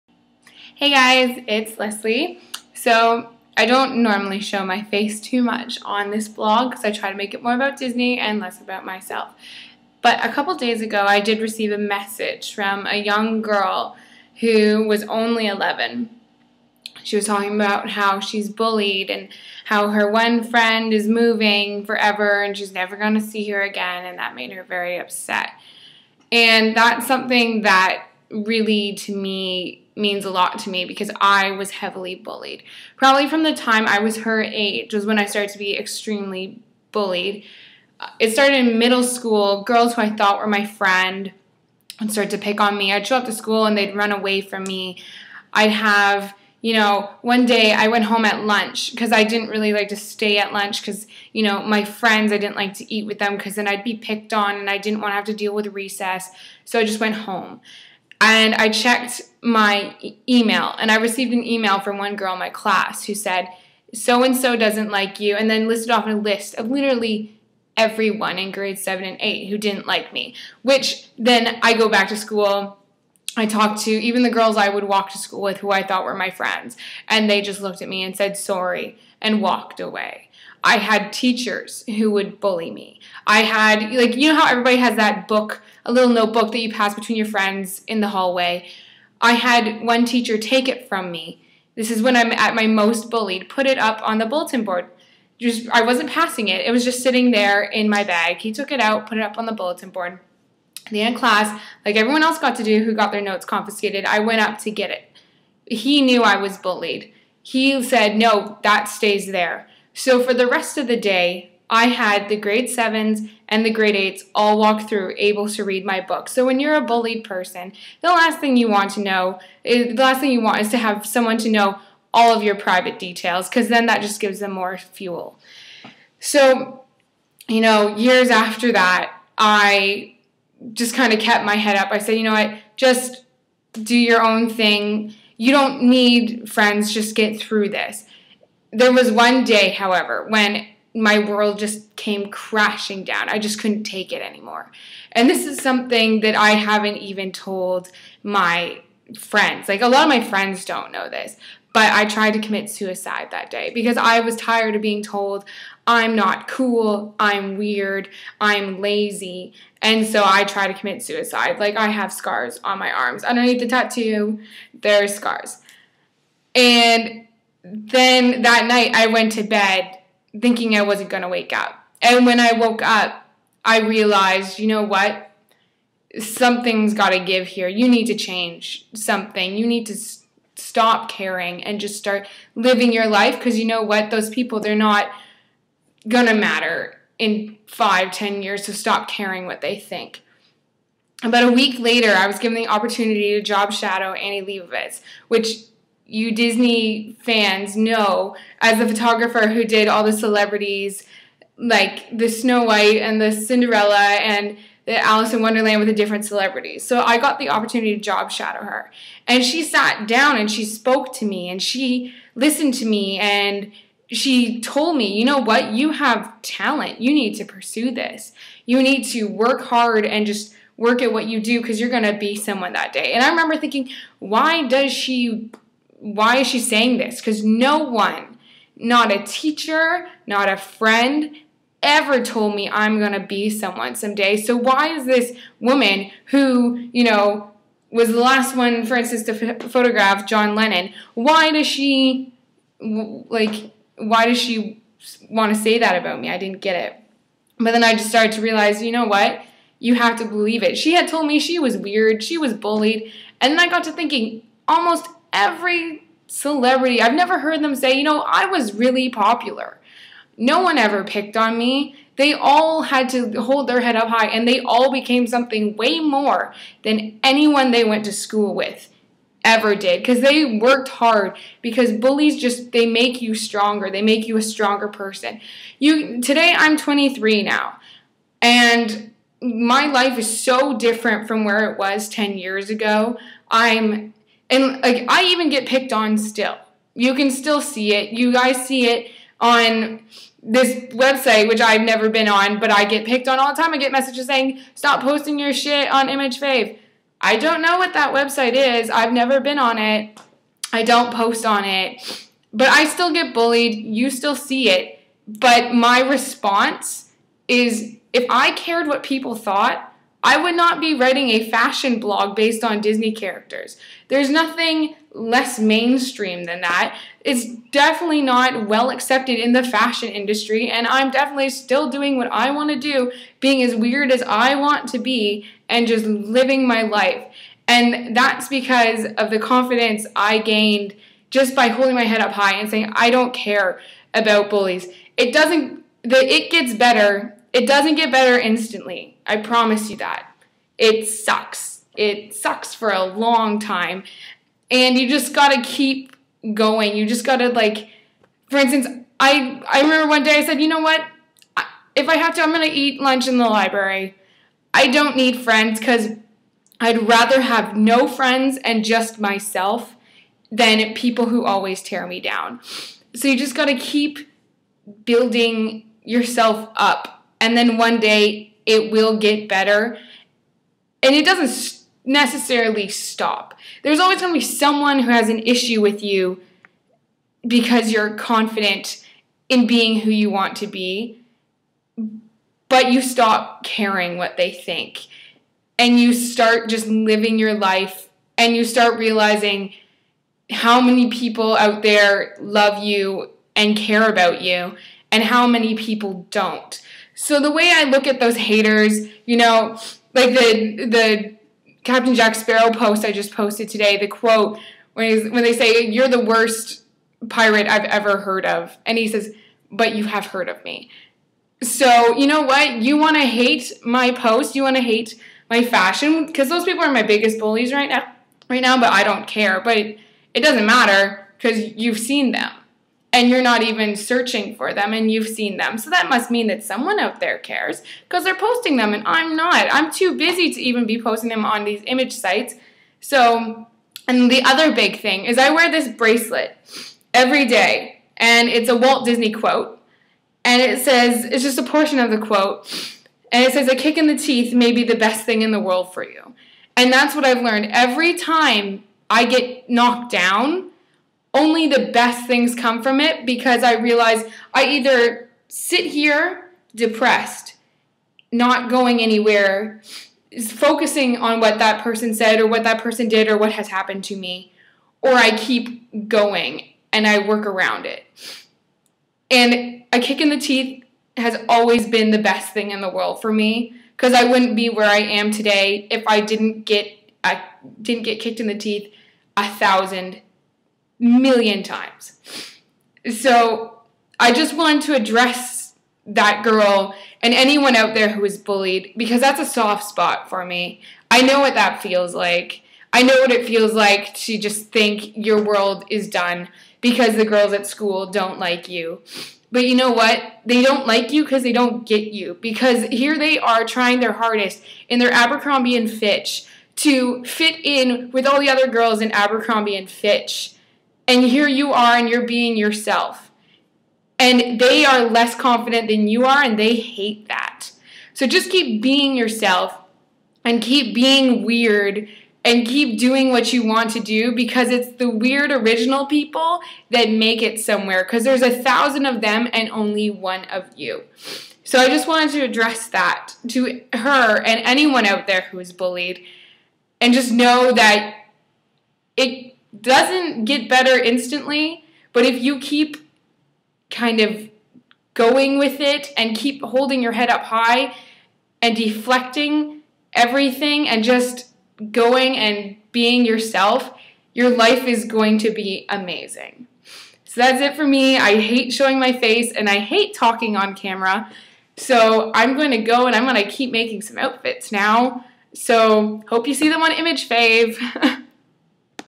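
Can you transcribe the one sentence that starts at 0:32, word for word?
Probably from the time I was her age was when I started to be extremely bullied.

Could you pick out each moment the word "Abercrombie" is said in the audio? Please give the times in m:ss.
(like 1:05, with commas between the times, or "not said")
8:25, 8:29.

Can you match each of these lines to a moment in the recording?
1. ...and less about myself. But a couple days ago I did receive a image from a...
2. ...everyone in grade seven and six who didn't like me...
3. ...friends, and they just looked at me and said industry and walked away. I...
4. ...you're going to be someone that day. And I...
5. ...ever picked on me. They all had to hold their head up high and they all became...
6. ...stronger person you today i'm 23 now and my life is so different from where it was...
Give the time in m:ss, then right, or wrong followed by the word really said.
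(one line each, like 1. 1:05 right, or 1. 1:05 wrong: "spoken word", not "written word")
1. 0:08 wrong: "message", not "image"
2. 1:07 wrong: "eight", not "six"
3. 1:16 wrong: "sorry", not "industry"
4. 3:41 right
5. 4:20 right
6. 4:34 right.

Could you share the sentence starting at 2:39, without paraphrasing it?
And so I tried to commit suicide.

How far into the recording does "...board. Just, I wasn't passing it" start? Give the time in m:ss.
1:34.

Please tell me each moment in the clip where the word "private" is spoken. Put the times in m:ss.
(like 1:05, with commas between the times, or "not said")
2:02.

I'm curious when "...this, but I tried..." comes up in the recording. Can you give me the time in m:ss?
2:31.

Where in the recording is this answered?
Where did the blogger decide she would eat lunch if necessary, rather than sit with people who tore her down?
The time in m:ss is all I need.
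5:53.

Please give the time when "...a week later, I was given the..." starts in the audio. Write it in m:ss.
3:11.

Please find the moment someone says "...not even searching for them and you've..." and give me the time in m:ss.
7:03.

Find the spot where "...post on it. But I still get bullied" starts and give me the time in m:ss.
5:01.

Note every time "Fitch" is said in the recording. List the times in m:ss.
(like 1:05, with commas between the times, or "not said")
8:25, 8:29.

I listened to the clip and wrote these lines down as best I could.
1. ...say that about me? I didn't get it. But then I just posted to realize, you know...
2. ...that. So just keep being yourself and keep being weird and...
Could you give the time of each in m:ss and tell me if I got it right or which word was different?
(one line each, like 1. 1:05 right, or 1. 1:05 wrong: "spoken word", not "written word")
1. 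4:05 wrong: "started", not "posted"
2. 8:37 right.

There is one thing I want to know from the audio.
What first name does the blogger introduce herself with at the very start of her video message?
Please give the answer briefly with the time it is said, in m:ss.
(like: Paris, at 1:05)
Leslie, at 0:01.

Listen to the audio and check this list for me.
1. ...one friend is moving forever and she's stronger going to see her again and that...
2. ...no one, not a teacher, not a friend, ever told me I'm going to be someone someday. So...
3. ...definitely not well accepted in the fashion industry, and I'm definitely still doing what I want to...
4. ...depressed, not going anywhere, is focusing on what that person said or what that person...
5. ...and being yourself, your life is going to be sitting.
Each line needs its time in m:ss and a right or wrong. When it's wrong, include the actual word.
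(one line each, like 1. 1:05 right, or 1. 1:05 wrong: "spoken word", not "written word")
1. 0:20 wrong: "never", not "stronger"
2. 3:47 right
3. 5:17 right
4. 7:36 right
5. 9:12 wrong: "amazing", not "sitting".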